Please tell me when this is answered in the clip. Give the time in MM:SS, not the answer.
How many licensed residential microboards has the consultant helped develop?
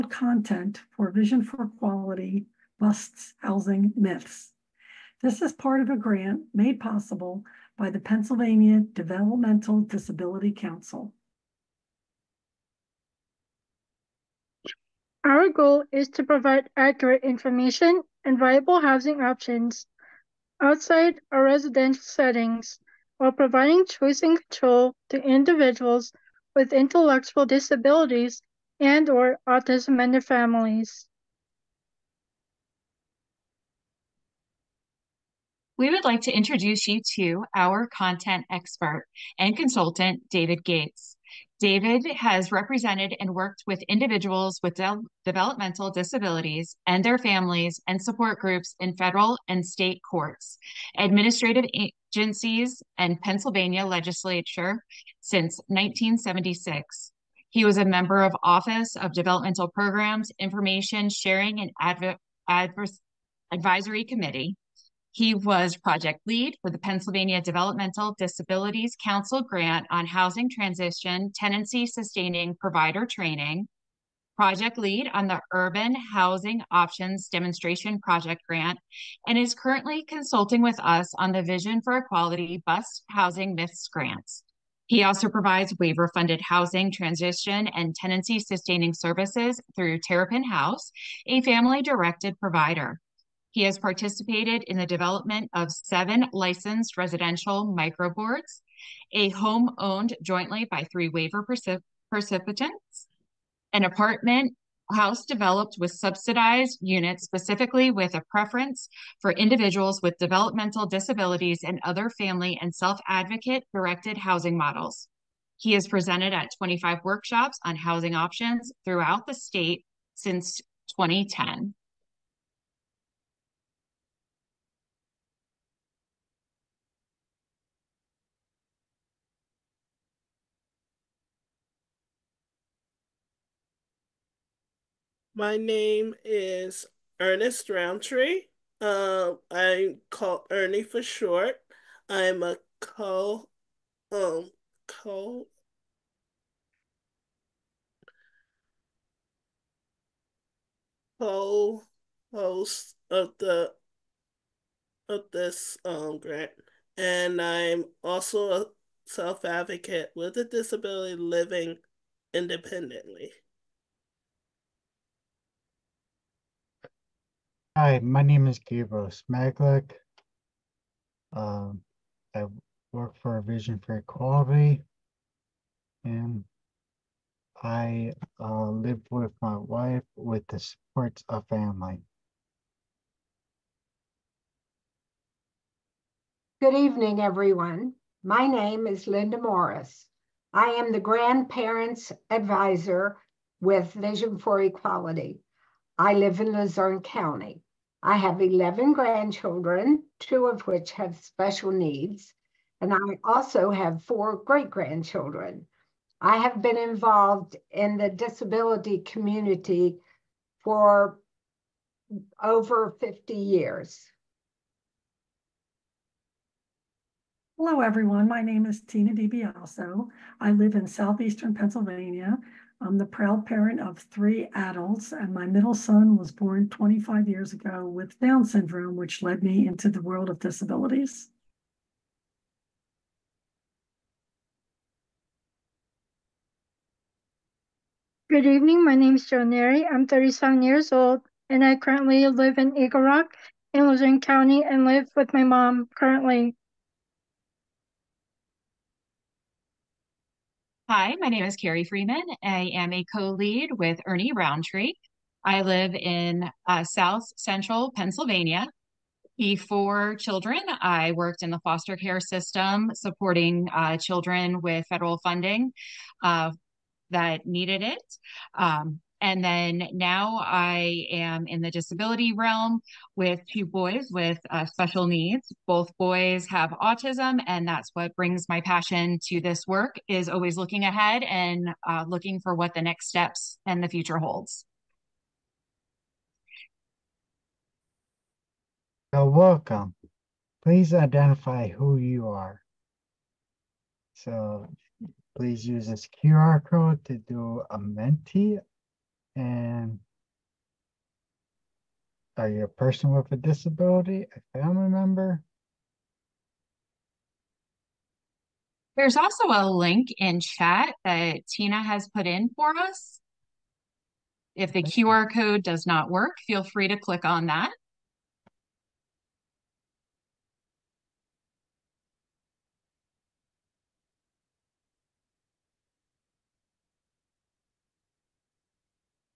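01:35.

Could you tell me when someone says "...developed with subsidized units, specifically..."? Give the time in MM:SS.
01:45.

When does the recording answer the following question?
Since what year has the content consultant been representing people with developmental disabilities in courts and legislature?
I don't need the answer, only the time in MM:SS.
00:55.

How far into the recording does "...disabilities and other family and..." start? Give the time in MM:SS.
01:50.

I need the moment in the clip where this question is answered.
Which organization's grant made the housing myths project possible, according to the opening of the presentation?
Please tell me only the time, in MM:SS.
00:07.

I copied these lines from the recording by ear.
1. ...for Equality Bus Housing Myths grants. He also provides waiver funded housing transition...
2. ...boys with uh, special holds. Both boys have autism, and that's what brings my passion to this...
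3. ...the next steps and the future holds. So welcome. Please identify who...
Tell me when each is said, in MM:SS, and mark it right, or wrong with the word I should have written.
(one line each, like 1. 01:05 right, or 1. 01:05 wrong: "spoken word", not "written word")
1. 01:21 right
2. 04:33 wrong: "needs", not "holds"
3. 04:42 right.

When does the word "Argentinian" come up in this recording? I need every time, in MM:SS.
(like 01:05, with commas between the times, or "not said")
not said.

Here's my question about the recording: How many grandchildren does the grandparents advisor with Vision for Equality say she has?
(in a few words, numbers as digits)
11.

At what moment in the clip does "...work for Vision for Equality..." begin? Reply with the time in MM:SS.
02:52.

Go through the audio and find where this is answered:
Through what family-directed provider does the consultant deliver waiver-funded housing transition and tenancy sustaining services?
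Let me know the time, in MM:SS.
01:29.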